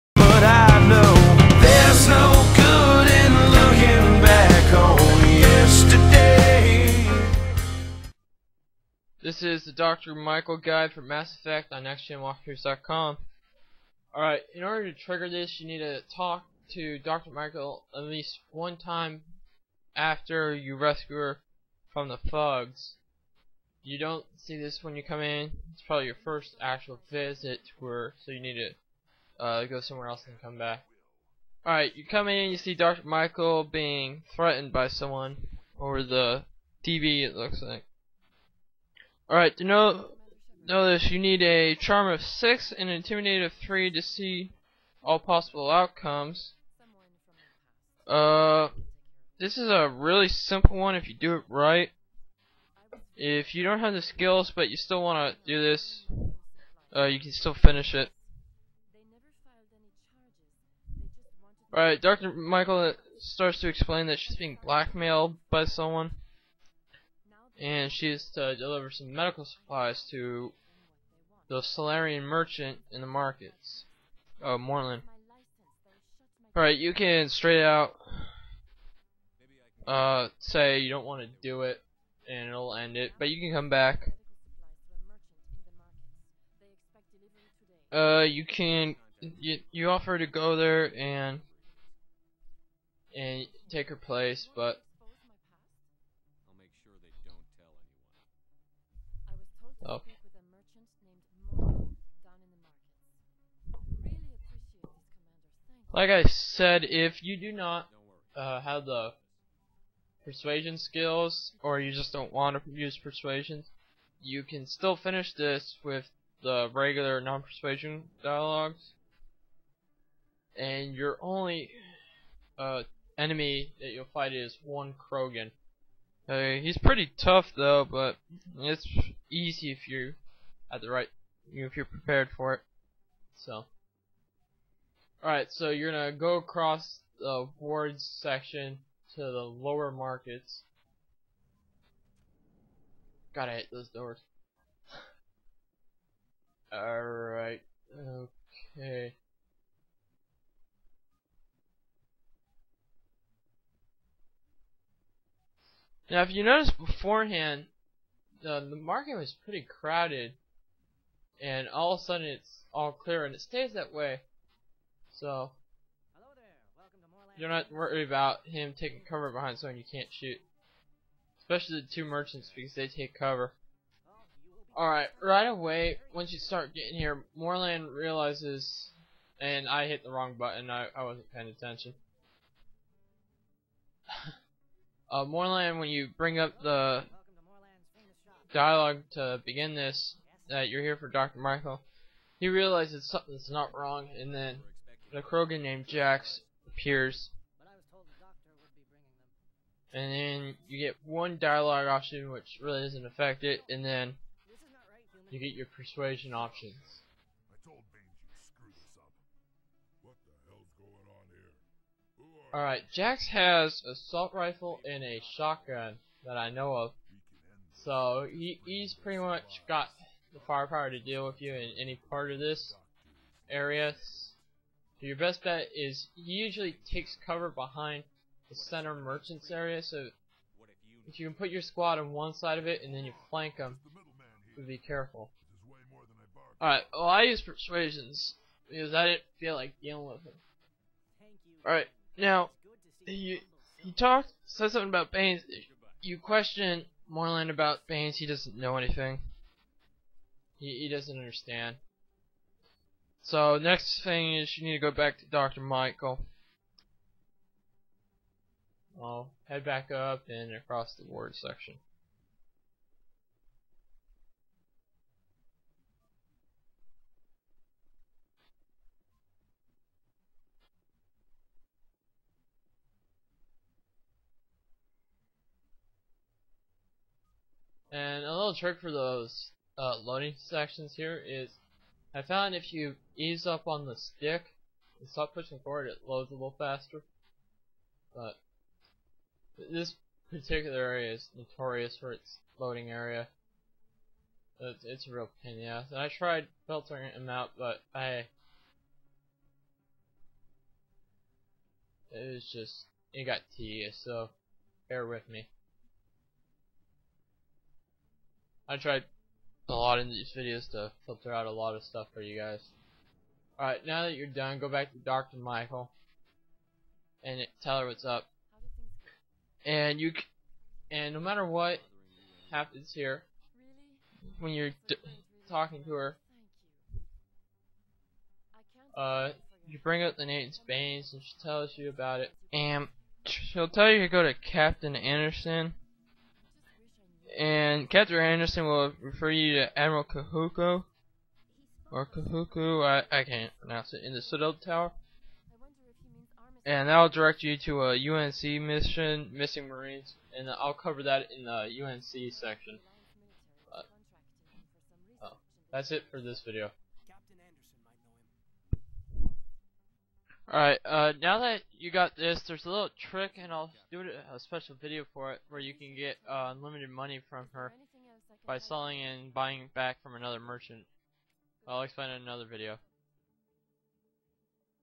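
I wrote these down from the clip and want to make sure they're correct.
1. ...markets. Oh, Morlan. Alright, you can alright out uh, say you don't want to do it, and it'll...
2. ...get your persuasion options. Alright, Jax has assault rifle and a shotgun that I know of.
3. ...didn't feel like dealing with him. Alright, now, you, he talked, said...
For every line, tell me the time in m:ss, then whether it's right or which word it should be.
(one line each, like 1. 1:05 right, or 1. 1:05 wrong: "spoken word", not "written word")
1. 1:13 wrong: "straight", not "alright"
2. 3:25 right
3. 3:59 right.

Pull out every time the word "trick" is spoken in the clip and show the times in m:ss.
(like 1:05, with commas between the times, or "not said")
4:38, 6:03.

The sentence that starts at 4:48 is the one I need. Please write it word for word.
But this particular area is notorious for its loading area.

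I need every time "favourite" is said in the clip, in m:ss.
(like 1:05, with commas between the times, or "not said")
not said.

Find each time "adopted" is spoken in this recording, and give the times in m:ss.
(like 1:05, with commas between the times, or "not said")
not said.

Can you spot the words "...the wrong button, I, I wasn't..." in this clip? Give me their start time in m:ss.
3:00.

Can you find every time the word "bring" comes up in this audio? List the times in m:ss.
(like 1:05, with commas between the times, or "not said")
3:06, 5:29.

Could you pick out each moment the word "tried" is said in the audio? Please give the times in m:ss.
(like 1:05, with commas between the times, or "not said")
4:56, 5:08.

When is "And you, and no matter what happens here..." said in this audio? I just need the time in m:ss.
5:19.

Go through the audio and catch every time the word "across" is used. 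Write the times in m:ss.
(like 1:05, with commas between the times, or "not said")
2:16, 4:20.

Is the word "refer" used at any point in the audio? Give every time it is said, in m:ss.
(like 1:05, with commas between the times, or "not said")
5:39.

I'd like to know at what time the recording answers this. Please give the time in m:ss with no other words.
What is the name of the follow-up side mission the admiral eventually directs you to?
5:49.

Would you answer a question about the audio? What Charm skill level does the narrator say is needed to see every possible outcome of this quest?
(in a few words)
6.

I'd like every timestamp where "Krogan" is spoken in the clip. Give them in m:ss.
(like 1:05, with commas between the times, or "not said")
2:04, 3:15.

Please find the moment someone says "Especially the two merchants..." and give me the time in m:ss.
2:51.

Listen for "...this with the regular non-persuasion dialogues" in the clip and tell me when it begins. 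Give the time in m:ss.
1:55.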